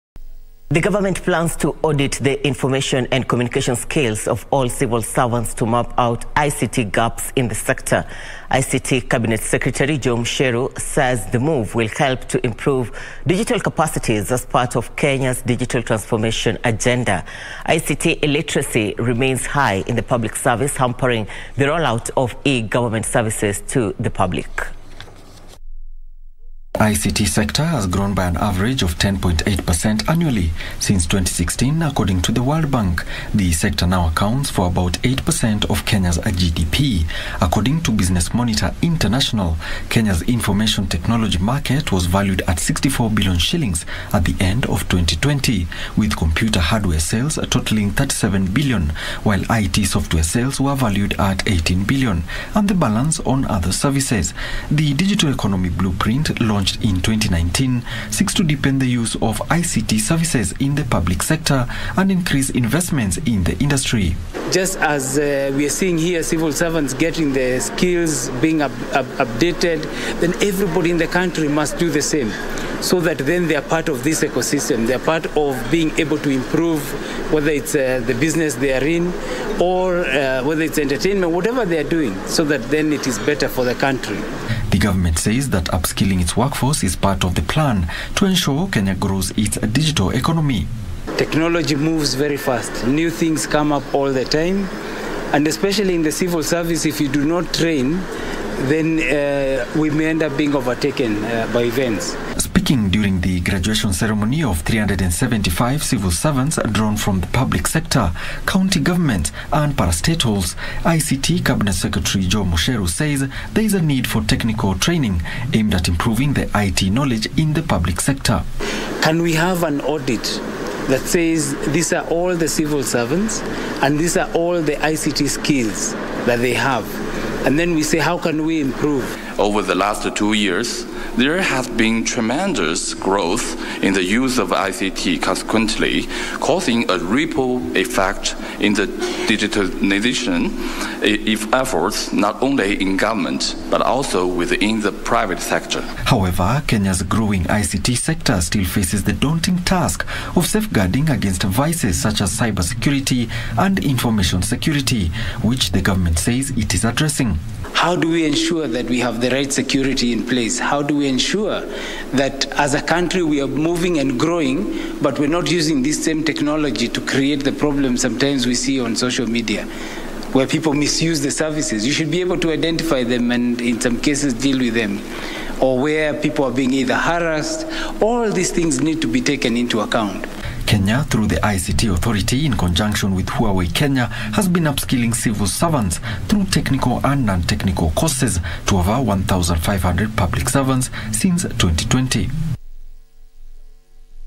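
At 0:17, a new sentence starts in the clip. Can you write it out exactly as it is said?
ICT illiteracy remains high in the public service, hampering the rollout of e-government services to the public.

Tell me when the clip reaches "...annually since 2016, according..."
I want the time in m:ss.
0:30.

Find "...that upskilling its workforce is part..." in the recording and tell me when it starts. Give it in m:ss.
1:25.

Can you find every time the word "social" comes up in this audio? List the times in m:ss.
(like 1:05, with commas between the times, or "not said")
2:48.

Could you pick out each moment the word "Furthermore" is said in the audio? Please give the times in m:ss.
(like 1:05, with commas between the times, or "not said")
not said.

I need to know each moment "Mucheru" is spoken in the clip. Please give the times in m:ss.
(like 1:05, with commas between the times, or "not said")
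0:10, 1:52.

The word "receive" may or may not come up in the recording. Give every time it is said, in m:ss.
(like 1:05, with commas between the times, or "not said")
not said.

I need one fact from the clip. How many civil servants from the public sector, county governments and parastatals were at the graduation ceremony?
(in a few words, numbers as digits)
375.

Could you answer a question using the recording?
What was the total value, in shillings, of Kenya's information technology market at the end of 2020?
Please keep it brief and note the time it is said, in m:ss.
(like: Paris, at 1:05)
64 billion shillings, at 0:42.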